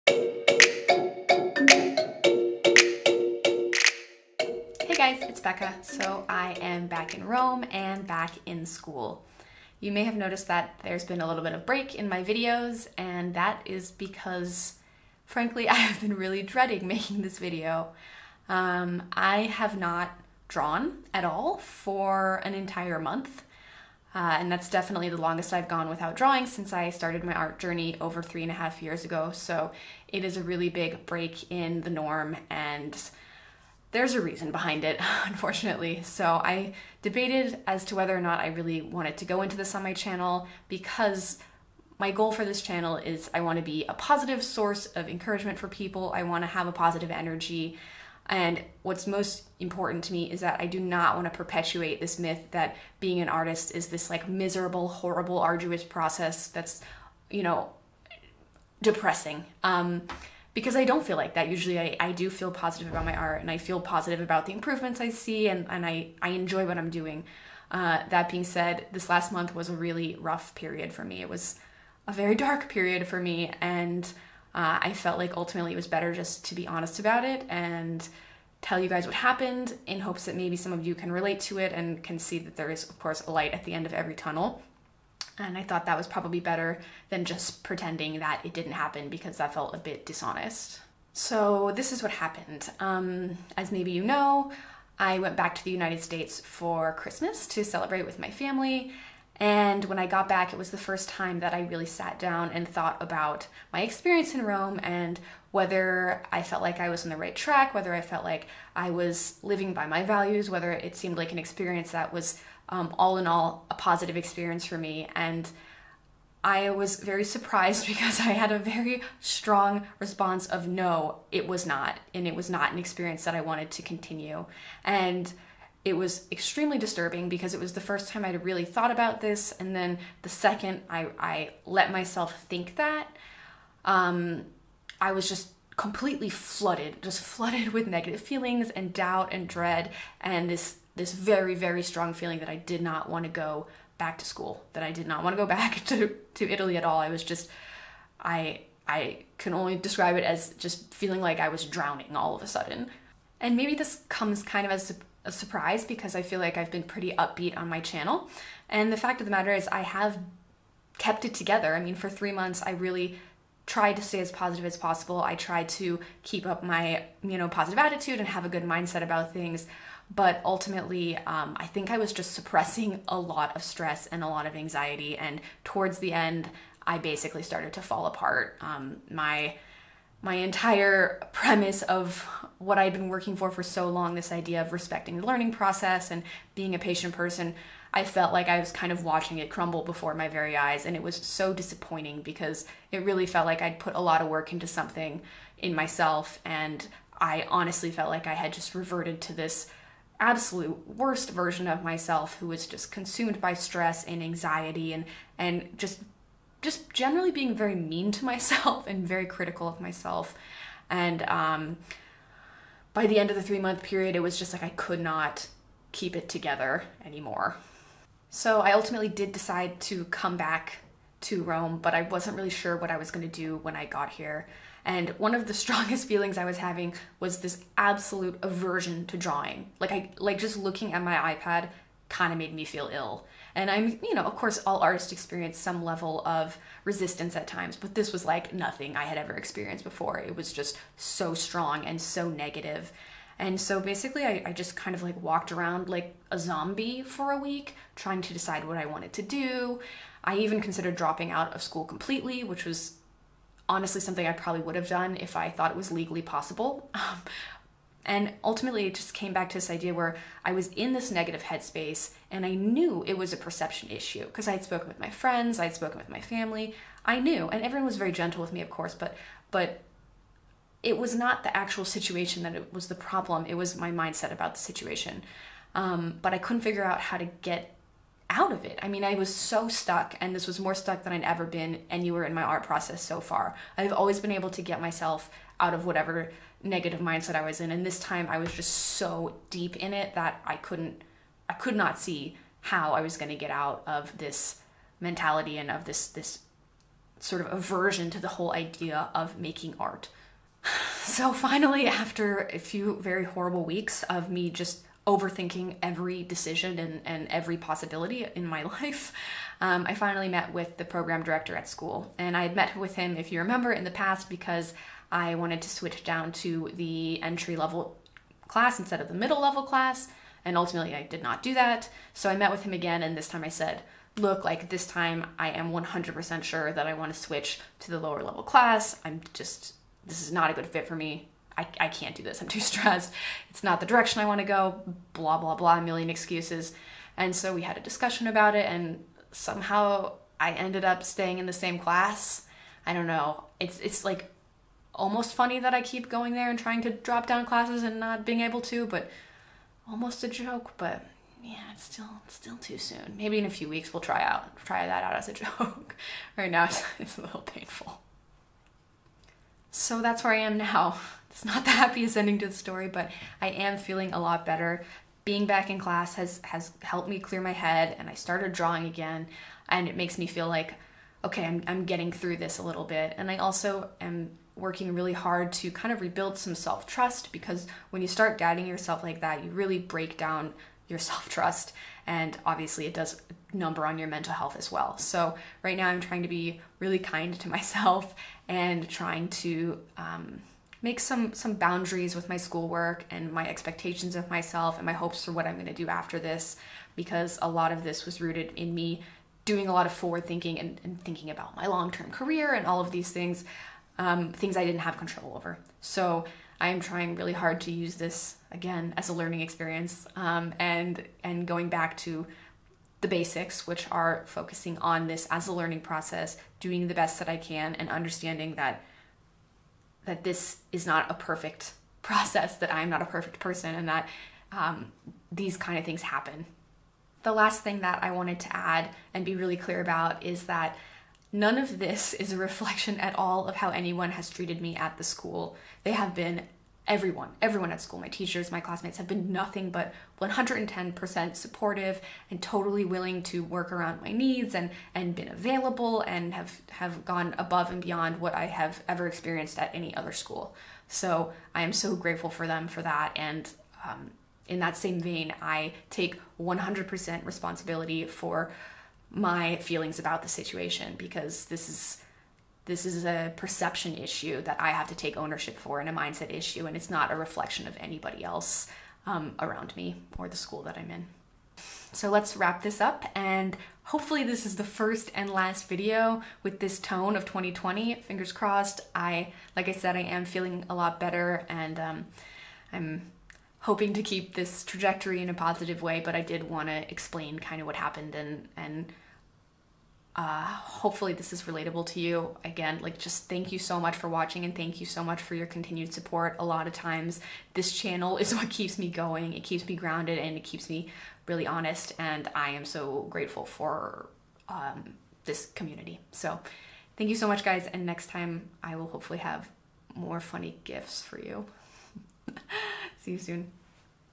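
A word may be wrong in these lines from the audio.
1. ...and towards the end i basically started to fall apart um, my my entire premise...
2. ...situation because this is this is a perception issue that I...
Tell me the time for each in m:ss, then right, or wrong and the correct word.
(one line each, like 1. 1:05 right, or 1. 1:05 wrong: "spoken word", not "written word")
1. 2:55 right
2. 7:40 right.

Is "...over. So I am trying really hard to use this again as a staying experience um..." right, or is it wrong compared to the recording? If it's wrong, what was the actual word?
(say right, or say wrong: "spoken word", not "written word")
wrong: "learning", not "staying".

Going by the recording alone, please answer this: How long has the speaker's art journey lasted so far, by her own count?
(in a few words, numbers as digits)
over three and a half years.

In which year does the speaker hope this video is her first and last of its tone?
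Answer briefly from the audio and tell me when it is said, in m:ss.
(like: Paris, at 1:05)
2020, at 7:57.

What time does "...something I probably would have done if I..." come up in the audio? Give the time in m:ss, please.
4:14.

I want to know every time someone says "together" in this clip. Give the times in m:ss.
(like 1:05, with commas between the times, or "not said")
2:41, 3:36.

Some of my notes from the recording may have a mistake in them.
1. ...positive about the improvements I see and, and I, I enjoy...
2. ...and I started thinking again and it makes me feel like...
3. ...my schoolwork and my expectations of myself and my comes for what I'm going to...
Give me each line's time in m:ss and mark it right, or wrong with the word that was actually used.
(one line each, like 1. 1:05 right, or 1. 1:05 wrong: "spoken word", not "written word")
1. 1:03 right
2. 6:07 wrong: "drawing", not "thinking"
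3. 6:32 wrong: "hopes", not "comes".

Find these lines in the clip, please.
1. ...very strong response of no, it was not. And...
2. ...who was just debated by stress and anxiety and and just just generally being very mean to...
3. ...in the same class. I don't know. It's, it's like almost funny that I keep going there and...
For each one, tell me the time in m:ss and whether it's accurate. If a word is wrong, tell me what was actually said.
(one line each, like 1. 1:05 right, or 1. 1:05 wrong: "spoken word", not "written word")
1. 1:58 right
2. 3:22 wrong: "consumed", not "debated"
3. 5:41 right.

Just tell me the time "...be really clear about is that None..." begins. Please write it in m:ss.
7:09.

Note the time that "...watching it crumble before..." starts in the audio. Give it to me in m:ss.
3:09.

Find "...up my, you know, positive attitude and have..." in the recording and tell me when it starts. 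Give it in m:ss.
2:46.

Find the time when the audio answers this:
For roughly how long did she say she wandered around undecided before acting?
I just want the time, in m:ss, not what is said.
4:07.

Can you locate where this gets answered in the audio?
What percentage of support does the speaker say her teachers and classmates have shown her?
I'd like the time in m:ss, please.
7:20.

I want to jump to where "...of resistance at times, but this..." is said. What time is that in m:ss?
3:56.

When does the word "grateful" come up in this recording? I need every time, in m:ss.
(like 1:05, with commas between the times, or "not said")
7:31, 8:23.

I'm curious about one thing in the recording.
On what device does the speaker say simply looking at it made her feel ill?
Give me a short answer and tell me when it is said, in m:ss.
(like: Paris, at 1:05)
iPad, at 3:51.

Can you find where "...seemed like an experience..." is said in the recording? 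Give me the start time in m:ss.
1:50.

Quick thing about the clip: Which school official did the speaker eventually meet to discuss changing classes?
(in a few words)
program director.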